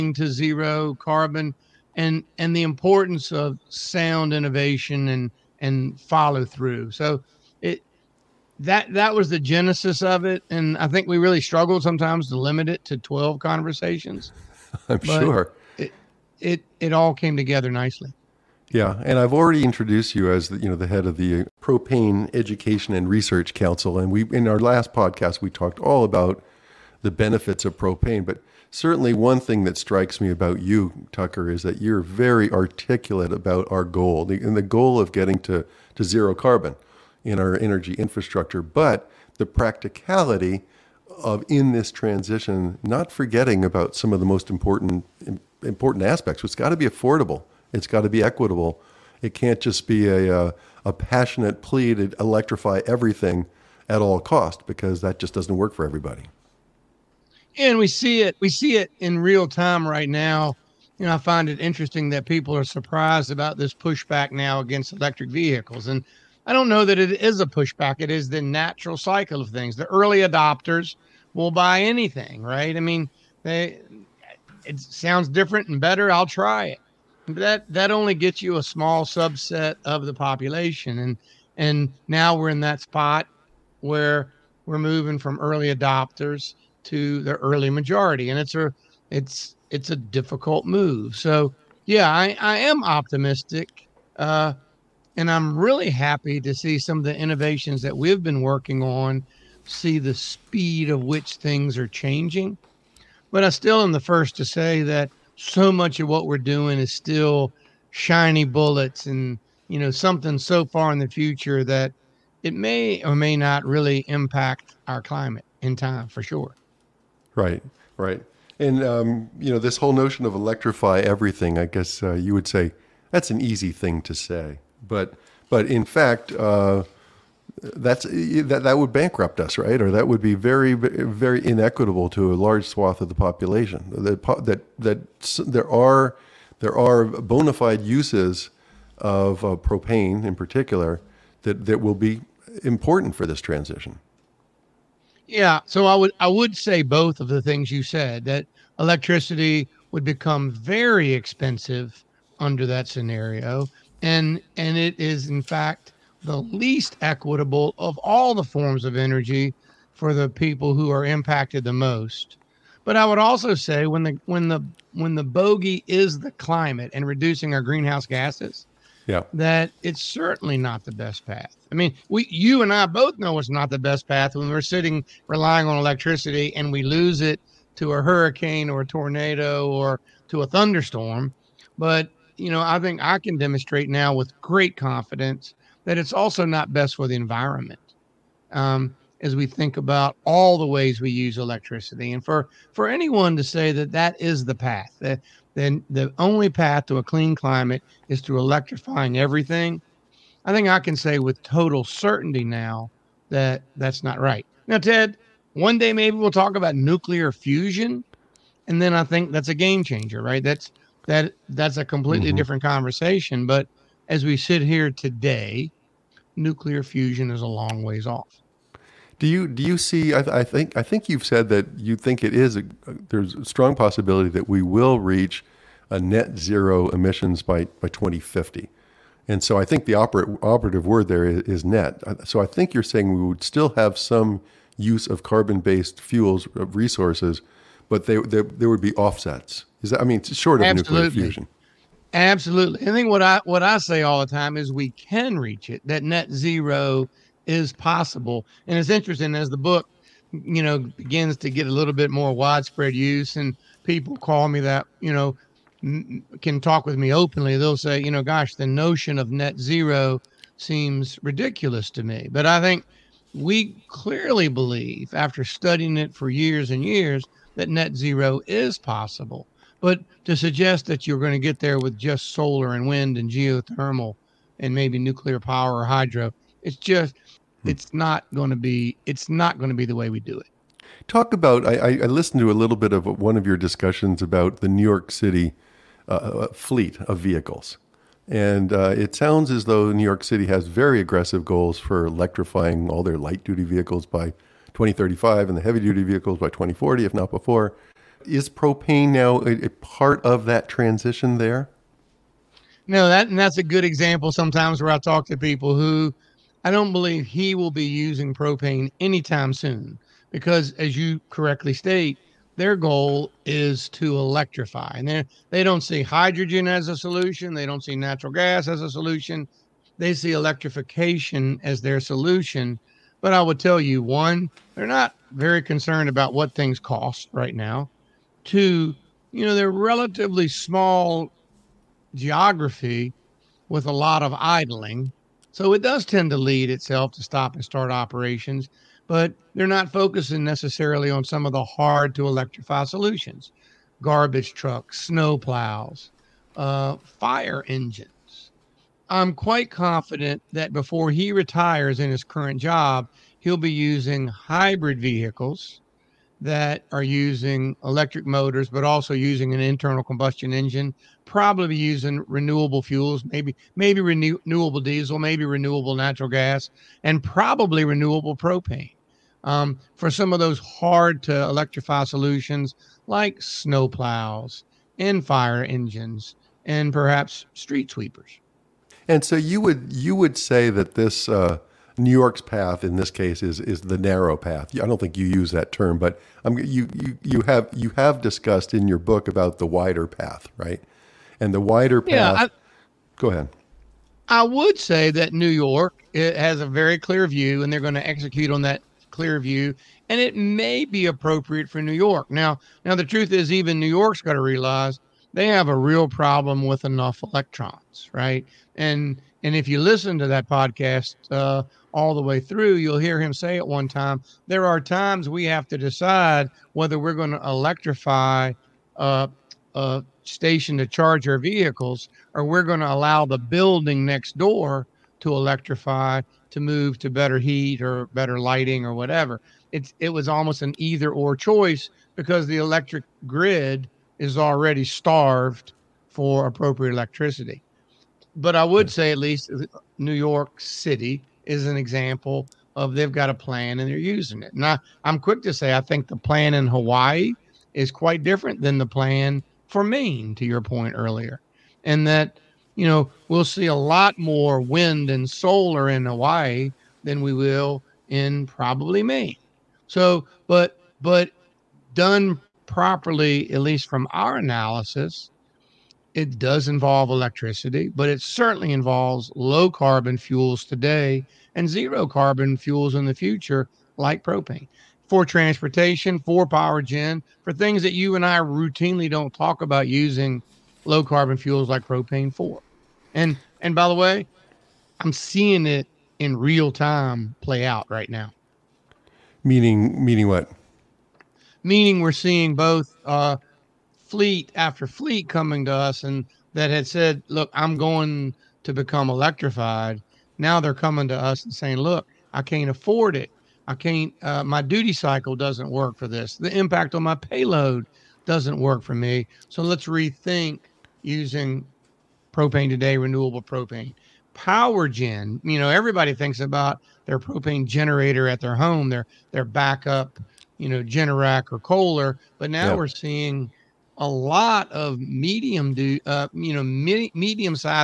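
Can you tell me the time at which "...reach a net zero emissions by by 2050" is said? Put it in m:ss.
3:44.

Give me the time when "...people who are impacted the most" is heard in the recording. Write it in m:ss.
2:40.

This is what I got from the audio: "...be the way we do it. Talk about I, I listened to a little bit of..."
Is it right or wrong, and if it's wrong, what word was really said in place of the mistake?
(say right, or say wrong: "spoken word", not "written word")
right.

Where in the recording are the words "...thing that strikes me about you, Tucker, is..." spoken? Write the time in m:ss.
0:29.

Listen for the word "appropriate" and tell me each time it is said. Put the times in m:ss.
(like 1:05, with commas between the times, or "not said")
6:41, 7:16.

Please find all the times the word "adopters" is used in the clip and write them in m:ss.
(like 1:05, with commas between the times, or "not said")
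1:10, 1:25.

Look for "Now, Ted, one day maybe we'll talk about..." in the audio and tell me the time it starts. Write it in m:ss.
3:24.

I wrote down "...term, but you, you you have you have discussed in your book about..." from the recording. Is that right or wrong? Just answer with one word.
right.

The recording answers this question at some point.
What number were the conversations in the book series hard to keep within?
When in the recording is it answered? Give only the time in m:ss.
0:12.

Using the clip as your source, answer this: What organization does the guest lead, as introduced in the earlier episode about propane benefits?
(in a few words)
Propane Education and Research Council.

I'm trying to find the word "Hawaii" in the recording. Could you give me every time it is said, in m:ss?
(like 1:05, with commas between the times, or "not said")
7:26, 7:36.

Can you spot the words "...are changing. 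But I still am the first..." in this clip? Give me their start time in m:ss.
1:41.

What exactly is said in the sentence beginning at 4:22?
But I think we clearly believe, after studying it for years and years, that net zero is possible.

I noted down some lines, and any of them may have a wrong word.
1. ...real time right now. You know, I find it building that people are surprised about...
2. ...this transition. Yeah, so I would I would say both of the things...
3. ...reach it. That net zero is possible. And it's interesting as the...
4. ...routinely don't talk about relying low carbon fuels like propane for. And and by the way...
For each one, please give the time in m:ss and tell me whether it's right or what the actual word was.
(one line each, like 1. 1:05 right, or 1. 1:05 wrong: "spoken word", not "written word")
1. 0:59 wrong: "interesting", not "building"
2. 2:23 right
3. 4:05 right
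4. 7:58 wrong: "using", not "relying".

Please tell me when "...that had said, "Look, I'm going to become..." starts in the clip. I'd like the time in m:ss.
8:16.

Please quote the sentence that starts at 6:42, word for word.
Now, now the truth is, even New York's got to realize they have a real problem with enough electrons, right?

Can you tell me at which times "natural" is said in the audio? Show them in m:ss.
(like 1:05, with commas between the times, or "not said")
1:08, 5:17, 6:05.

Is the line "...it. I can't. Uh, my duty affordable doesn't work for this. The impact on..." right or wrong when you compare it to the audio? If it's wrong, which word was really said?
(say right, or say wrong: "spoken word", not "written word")
wrong: "cycle", not "affordable".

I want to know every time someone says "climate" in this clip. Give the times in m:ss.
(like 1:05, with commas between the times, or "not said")
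1:55, 2:46, 3:17.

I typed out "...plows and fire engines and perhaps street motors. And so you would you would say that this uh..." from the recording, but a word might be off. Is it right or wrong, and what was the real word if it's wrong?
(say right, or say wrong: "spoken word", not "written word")
wrong: "sweepers", not "motors".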